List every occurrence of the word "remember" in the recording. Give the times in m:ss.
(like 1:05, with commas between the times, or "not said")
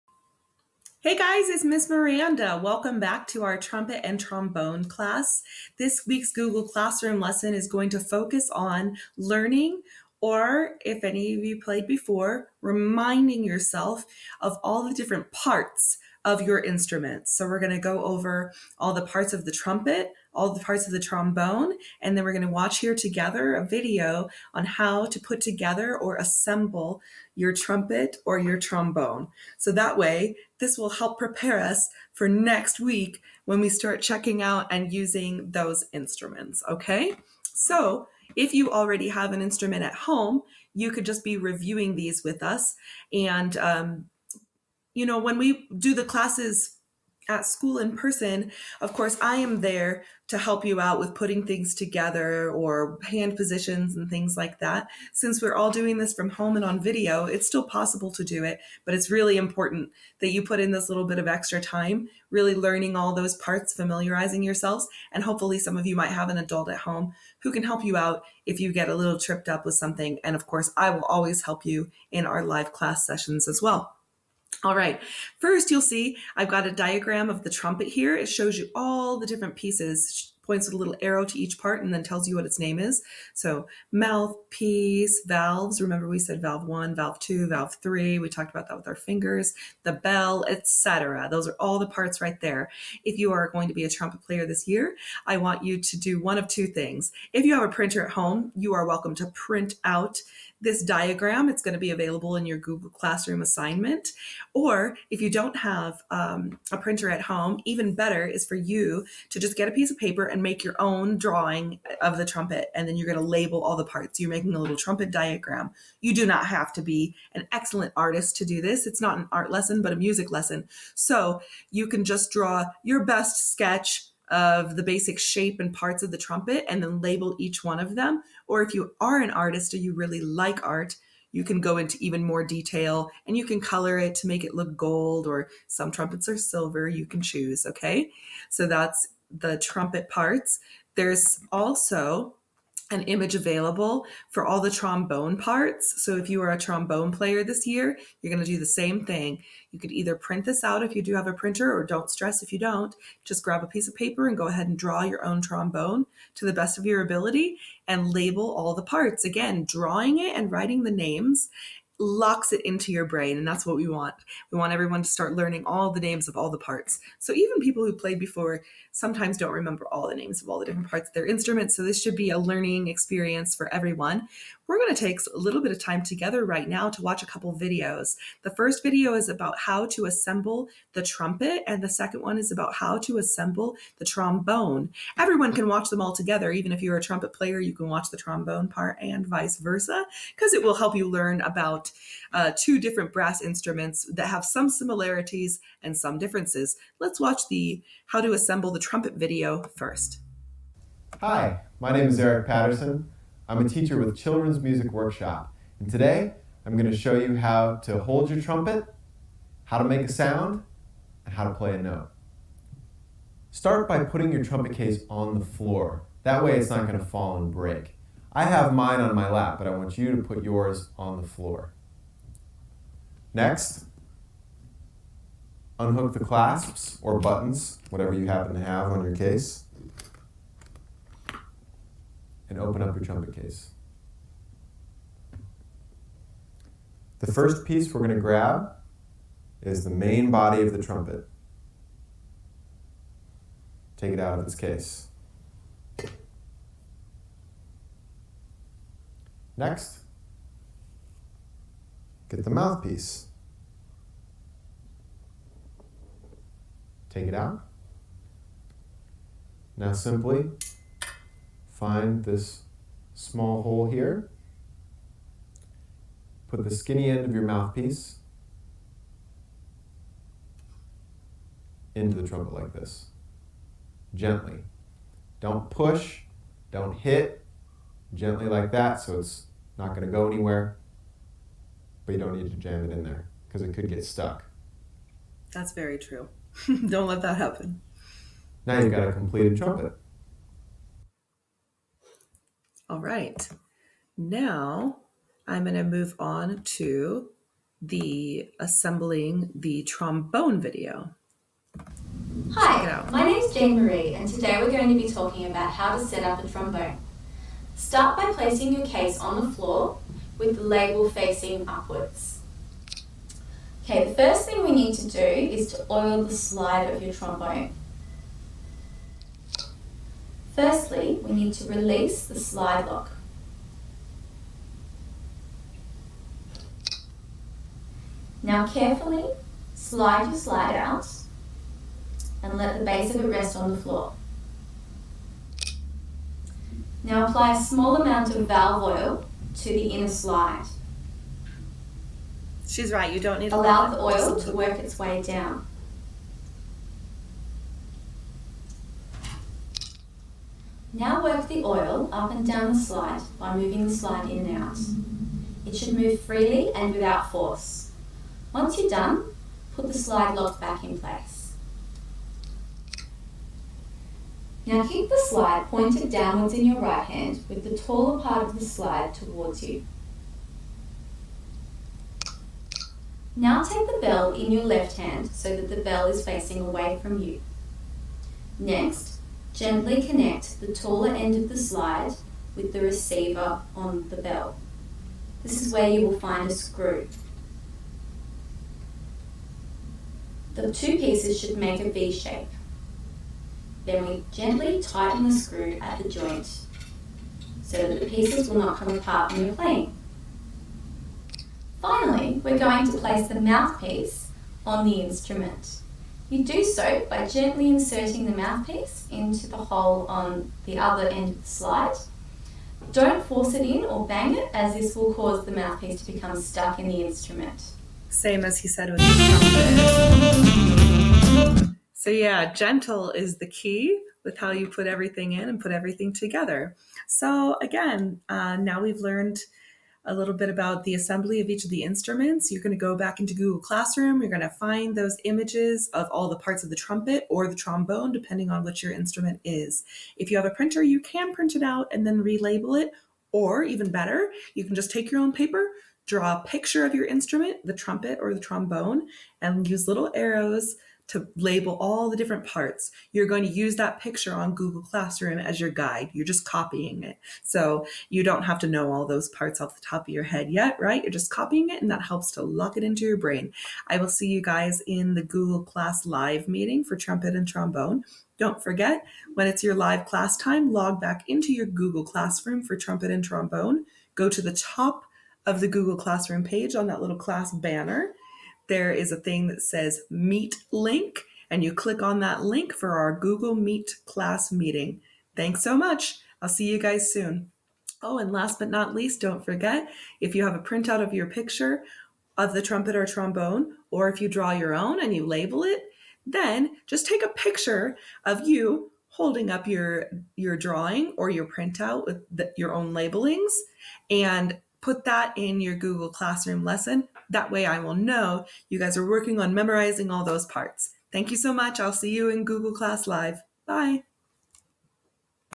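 1:25, 2:49.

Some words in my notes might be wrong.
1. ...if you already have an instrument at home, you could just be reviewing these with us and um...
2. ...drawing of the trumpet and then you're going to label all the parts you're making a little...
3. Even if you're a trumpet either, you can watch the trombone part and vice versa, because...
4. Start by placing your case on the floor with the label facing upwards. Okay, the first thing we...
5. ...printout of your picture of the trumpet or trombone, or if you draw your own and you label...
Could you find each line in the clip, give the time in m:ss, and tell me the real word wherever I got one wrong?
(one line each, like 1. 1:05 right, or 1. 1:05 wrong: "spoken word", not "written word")
1. 0:38 right
2. 1:51 right
3. 3:06 wrong: "player", not "either"
4. 5:07 right
5. 8:10 right.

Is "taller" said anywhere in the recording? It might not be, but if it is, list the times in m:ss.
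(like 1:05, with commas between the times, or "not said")
6:07, 6:20.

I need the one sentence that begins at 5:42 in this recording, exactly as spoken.
She's right, you don't need Allow the oil to work its way down.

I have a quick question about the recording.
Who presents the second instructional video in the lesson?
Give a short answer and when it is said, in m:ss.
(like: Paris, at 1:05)
Jane Marie, at 5:03.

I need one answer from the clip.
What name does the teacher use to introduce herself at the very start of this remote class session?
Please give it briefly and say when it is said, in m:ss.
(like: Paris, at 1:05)
Miss Miranda, at 0:01.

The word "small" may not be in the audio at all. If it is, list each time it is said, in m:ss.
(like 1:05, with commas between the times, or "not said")
4:23, 5:37.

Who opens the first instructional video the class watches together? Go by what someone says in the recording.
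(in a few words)
Eric Patterson.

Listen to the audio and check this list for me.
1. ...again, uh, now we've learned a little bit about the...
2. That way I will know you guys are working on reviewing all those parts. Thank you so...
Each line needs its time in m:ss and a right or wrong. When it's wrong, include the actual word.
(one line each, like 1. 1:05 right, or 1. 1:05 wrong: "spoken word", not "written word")
1. 7:07 right
2. 8:27 wrong: "memorizing", not "reviewing".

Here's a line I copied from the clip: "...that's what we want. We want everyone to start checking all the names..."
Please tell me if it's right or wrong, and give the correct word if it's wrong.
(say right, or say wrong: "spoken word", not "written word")
wrong: "learning", not "checking".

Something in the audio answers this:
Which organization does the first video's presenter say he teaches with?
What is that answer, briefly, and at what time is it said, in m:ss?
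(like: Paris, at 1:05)
Children's Music Workshop, at 3:24.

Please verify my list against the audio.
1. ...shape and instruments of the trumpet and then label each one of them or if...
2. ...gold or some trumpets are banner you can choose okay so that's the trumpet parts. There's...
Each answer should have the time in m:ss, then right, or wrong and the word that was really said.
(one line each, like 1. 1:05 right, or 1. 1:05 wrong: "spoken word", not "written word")
1. 2:05 wrong: "parts", not "instruments"
2. 2:14 wrong: "silver", not "banner".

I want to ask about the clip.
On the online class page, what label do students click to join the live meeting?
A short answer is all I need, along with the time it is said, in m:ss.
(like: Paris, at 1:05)
Meet Link, at 8:00.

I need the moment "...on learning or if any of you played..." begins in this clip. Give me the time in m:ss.
0:08.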